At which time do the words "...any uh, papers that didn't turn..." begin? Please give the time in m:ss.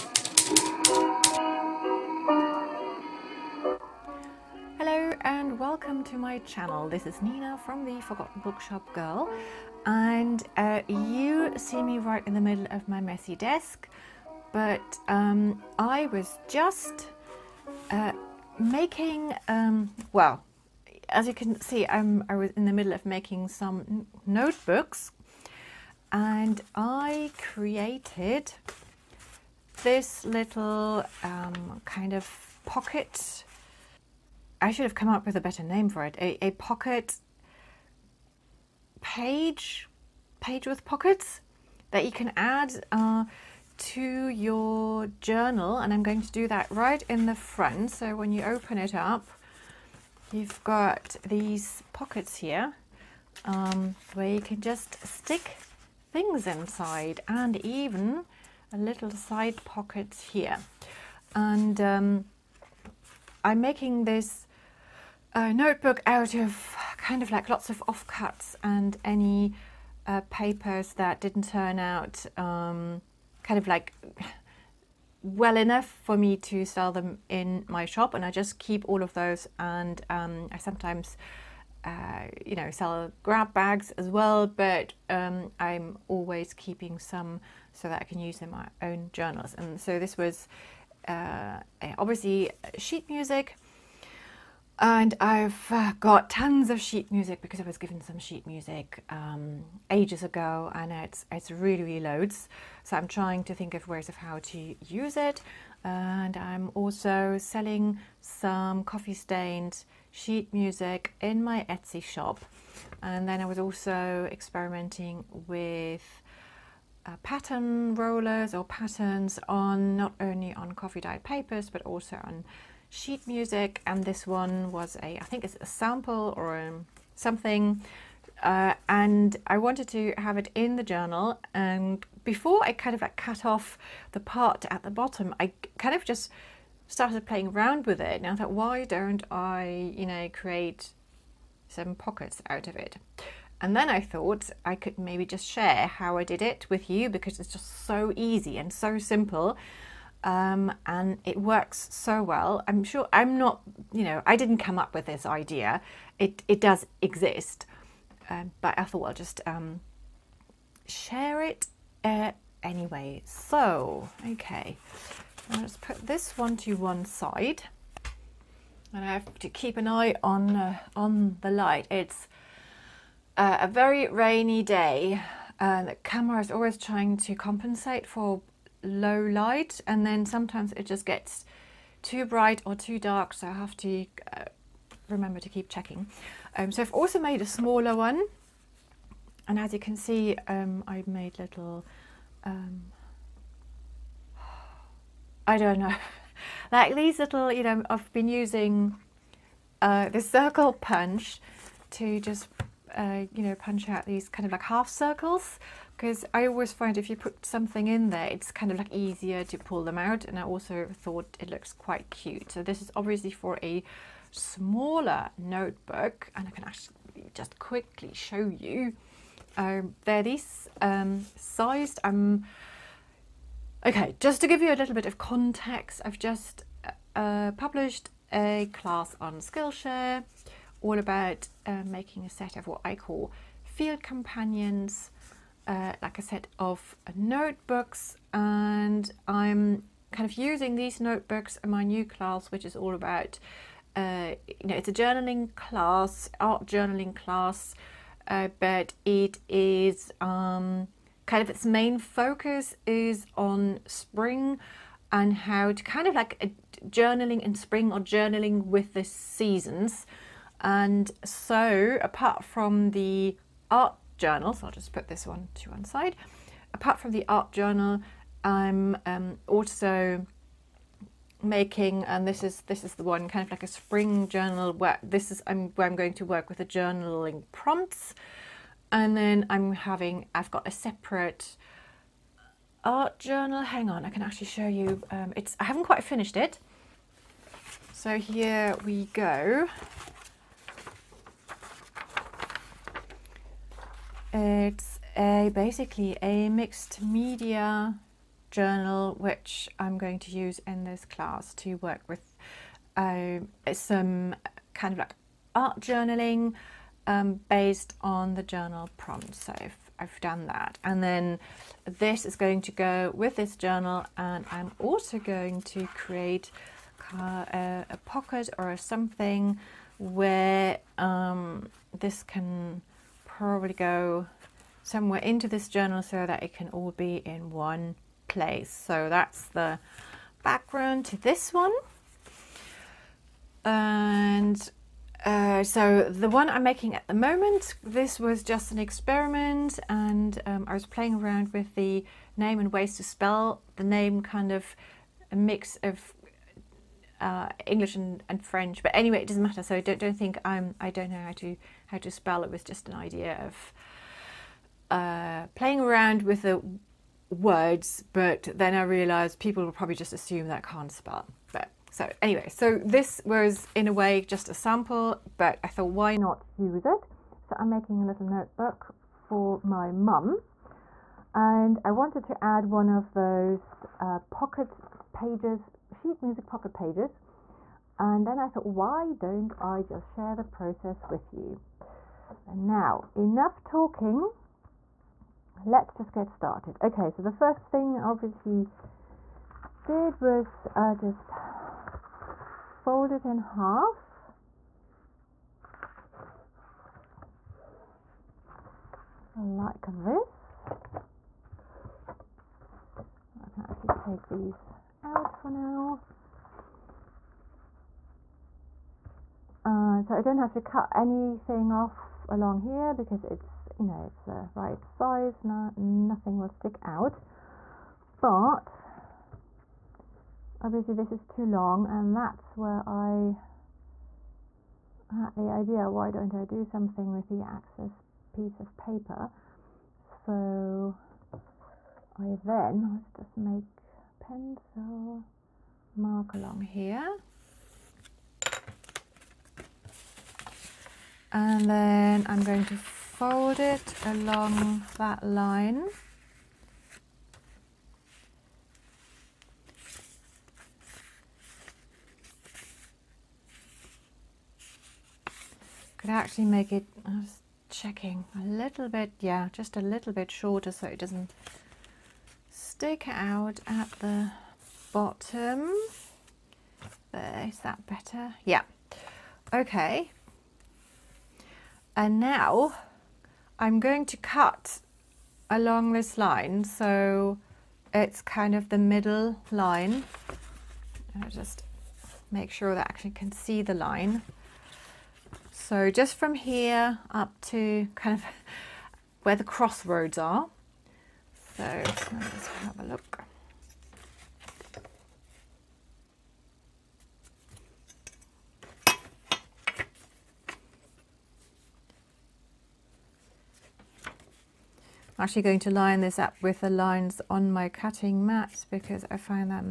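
1:09.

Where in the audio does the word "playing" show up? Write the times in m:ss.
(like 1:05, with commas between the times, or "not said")
2:17, 5:40, 5:55.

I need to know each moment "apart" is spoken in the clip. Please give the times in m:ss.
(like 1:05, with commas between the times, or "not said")
4:22, 4:26.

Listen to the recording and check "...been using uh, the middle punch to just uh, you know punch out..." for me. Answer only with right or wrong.
wrong.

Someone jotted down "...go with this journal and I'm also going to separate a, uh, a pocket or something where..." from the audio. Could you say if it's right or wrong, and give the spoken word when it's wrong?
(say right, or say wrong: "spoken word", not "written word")
wrong: "create", not "separate".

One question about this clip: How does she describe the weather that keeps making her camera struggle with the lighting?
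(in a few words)
A very rainy day.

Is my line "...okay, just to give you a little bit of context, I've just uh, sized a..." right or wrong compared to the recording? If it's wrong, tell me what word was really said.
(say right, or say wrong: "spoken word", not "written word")
wrong: "published", not "sized".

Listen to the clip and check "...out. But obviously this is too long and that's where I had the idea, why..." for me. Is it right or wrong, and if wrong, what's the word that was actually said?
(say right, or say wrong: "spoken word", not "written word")
right.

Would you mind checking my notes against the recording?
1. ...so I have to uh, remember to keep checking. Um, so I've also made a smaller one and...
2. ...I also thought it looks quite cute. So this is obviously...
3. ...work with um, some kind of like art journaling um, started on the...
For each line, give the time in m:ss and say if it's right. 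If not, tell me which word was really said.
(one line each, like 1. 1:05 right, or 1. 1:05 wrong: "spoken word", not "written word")
1. 3:03 right
2. 3:30 right
3. 5:01 wrong: "based", not "started".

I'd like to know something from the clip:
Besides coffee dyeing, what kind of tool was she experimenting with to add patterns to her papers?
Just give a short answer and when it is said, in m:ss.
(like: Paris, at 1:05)
Pattern rollers, at 1:57.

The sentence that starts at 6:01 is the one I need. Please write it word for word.
But so anyway, so this was in a way just a sample, but I thought why not use it?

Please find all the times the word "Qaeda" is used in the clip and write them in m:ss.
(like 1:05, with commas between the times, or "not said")
not said.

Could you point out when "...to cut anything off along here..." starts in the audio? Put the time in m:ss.
6:50.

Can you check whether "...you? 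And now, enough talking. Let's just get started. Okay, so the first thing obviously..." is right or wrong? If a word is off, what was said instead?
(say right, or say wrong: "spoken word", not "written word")
right.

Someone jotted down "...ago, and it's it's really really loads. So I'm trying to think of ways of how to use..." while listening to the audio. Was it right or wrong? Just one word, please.
right.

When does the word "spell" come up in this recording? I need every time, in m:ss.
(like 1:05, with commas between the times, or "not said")
5:43, 5:52, 6:00.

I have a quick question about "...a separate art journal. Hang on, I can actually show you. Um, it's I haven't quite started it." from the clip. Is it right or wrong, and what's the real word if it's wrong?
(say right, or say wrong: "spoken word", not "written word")
wrong: "finished", not "started".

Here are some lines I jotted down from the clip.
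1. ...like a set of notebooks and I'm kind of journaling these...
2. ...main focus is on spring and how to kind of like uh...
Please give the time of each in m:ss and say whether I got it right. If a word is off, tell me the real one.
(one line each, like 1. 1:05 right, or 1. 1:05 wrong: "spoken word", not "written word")
1. 3:56 wrong: "using", not "journaling"
2. 4:11 right.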